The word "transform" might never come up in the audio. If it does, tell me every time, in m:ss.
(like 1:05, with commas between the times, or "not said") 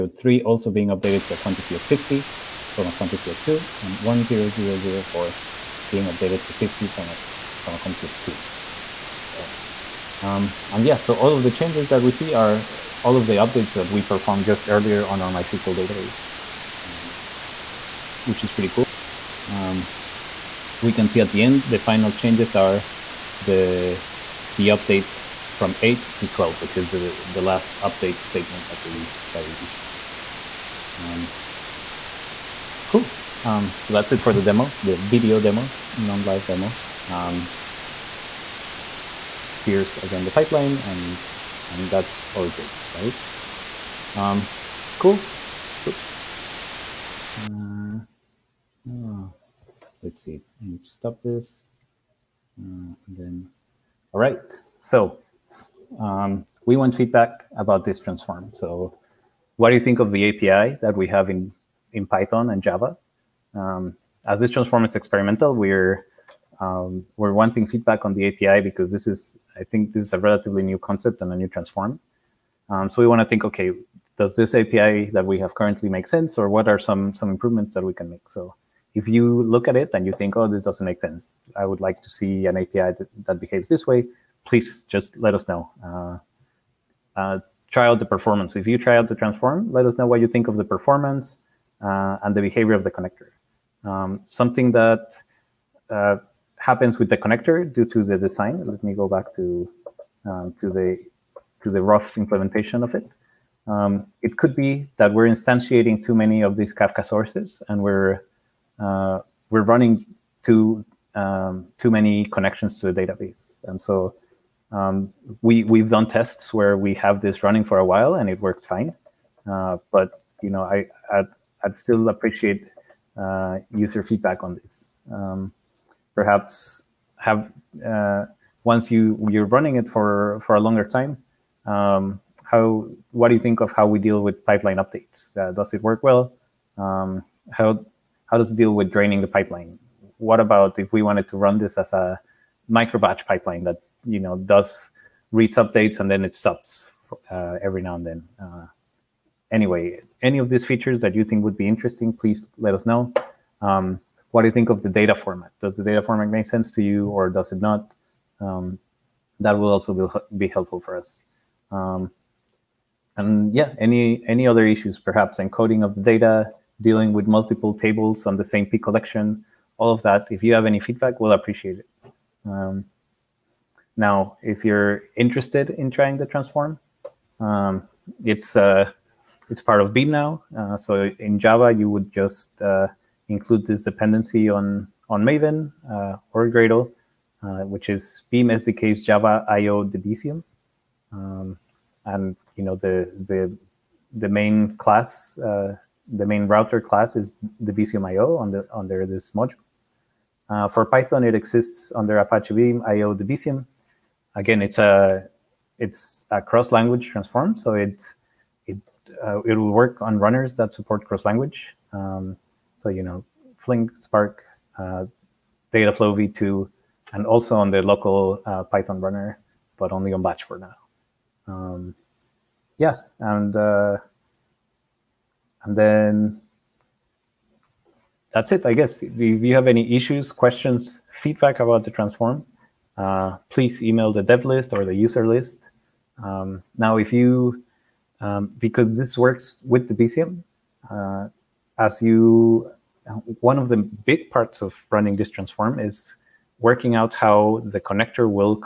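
0:57, 1:04, 1:11, 1:29, 2:56, 3:27, 3:51, 4:05.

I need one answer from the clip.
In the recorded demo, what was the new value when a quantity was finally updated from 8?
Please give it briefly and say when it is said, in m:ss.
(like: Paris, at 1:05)
12, at 0:26.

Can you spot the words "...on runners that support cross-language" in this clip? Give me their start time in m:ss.
3:30.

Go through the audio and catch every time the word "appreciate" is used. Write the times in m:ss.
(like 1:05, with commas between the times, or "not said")
2:02, 2:51.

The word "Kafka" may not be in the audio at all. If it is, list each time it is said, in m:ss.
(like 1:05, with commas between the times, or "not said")
1:46.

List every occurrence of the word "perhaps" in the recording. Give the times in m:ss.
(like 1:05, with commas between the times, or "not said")
2:06, 2:44.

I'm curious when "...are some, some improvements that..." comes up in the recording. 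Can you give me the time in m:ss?
1:16.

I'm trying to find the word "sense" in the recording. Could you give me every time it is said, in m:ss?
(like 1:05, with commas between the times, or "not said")
1:16, 1:21, 2:36.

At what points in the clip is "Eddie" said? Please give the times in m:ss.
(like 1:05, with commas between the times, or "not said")
not said.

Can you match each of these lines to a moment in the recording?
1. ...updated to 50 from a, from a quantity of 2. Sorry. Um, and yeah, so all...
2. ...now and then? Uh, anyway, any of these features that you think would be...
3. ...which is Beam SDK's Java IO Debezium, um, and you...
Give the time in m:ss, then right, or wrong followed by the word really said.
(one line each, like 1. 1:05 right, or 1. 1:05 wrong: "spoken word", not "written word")
1. 0:06 right
2. 2:27 right
3. 3:07 right.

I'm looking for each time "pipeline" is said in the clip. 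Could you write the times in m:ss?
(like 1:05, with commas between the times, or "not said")
0:40, 2:14, 2:19, 2:23.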